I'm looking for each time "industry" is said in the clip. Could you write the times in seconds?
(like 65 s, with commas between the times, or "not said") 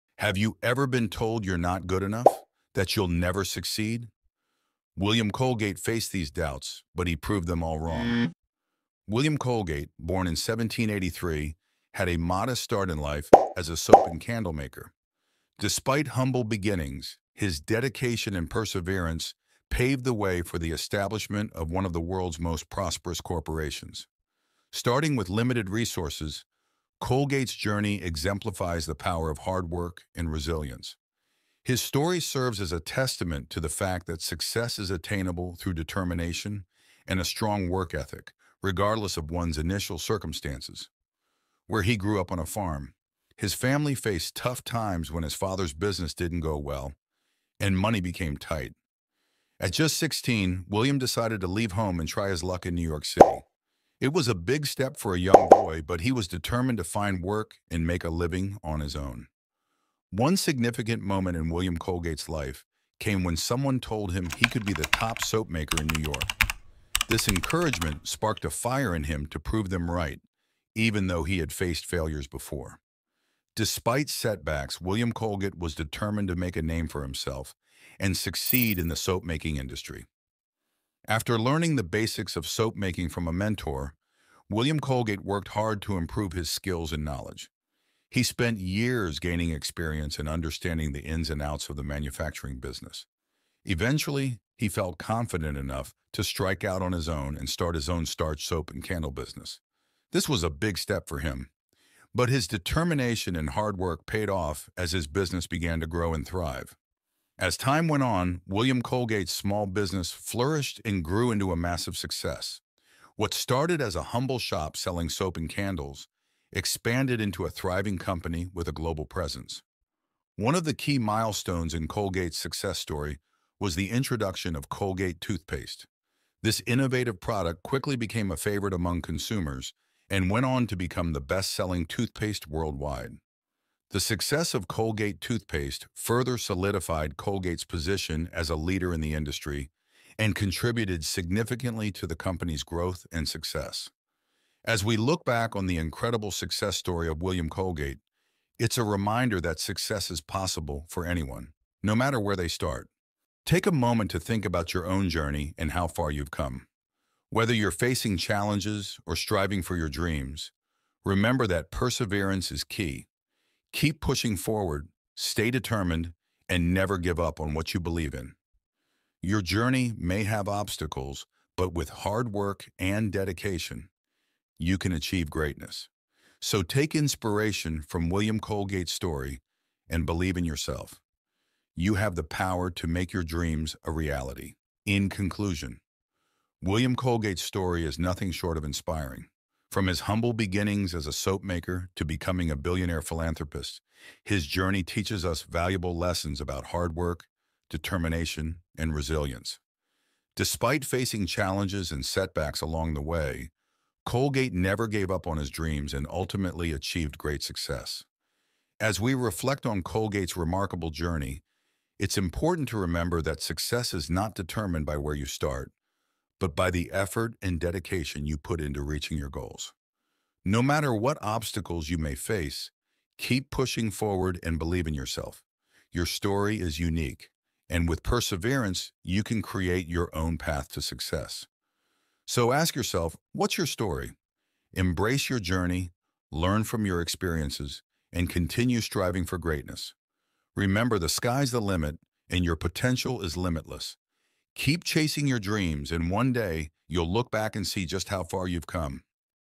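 79 s, 139 s.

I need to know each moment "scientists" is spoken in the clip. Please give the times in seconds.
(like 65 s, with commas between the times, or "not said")
not said.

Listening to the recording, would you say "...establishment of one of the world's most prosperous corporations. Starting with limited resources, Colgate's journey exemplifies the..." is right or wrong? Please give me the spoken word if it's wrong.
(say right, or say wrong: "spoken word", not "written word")
right.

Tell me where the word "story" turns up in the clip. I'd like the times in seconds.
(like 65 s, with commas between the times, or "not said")
31 s, 122 s, 146 s, 178 s, 187 s, 226 s, 233 s.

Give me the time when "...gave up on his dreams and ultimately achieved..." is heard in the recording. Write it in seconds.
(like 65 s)
204 s.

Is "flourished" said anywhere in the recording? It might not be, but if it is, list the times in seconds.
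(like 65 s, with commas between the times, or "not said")
110 s.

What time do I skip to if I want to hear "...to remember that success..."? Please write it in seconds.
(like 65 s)
212 s.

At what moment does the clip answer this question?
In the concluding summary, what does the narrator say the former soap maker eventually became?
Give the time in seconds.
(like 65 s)
192 s.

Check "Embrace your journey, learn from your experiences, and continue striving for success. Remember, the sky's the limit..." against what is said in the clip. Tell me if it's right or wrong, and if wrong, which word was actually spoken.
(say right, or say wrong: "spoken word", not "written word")
wrong: "greatness", not "success".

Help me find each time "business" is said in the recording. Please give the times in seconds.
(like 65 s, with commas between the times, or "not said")
45 s, 92 s, 99 s, 105 s, 109 s.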